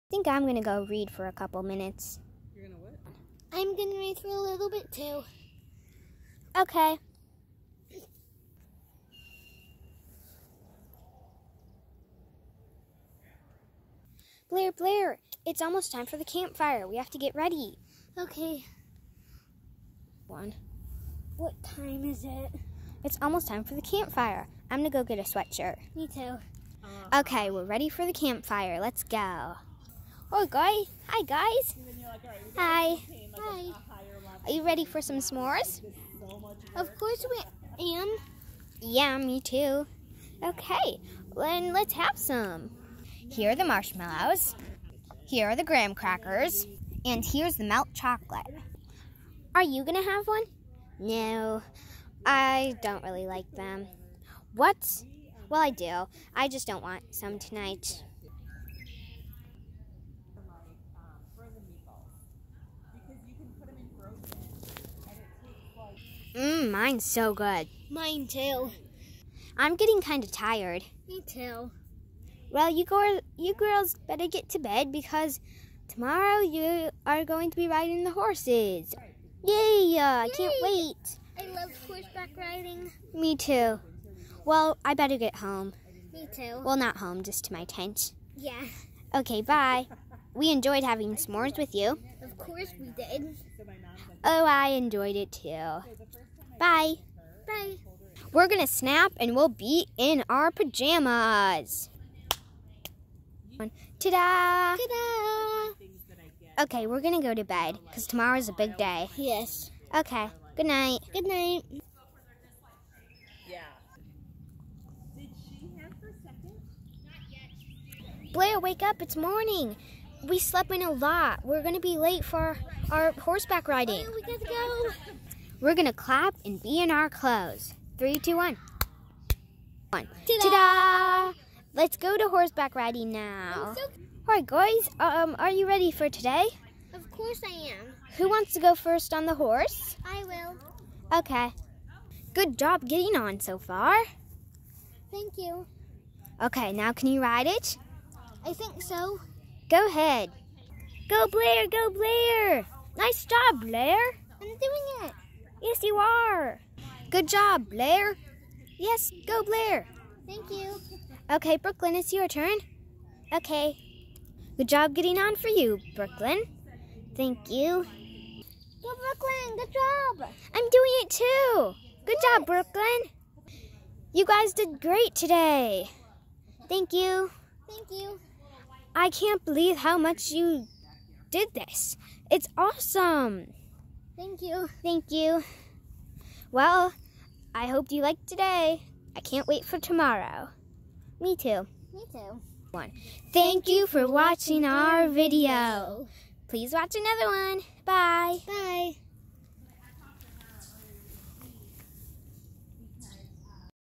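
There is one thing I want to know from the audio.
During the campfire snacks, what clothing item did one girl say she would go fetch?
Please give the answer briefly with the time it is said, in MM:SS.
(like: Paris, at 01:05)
Sweatshirt, at 00:25.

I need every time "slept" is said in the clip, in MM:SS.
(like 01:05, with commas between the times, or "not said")
02:00.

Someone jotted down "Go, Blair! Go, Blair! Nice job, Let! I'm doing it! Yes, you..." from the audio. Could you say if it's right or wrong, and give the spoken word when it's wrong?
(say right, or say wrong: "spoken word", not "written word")
wrong: "Blair", not "Let".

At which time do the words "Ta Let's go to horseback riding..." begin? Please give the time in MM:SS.
02:10.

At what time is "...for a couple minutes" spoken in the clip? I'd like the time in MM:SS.
00:01.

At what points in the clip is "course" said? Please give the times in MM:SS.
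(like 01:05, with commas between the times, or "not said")
00:36, 01:32, 02:17.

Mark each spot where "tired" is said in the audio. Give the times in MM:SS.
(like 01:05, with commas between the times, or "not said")
01:10.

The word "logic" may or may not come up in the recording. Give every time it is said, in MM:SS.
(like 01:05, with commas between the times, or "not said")
not said.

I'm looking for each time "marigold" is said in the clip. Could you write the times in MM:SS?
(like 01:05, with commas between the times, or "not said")
not said.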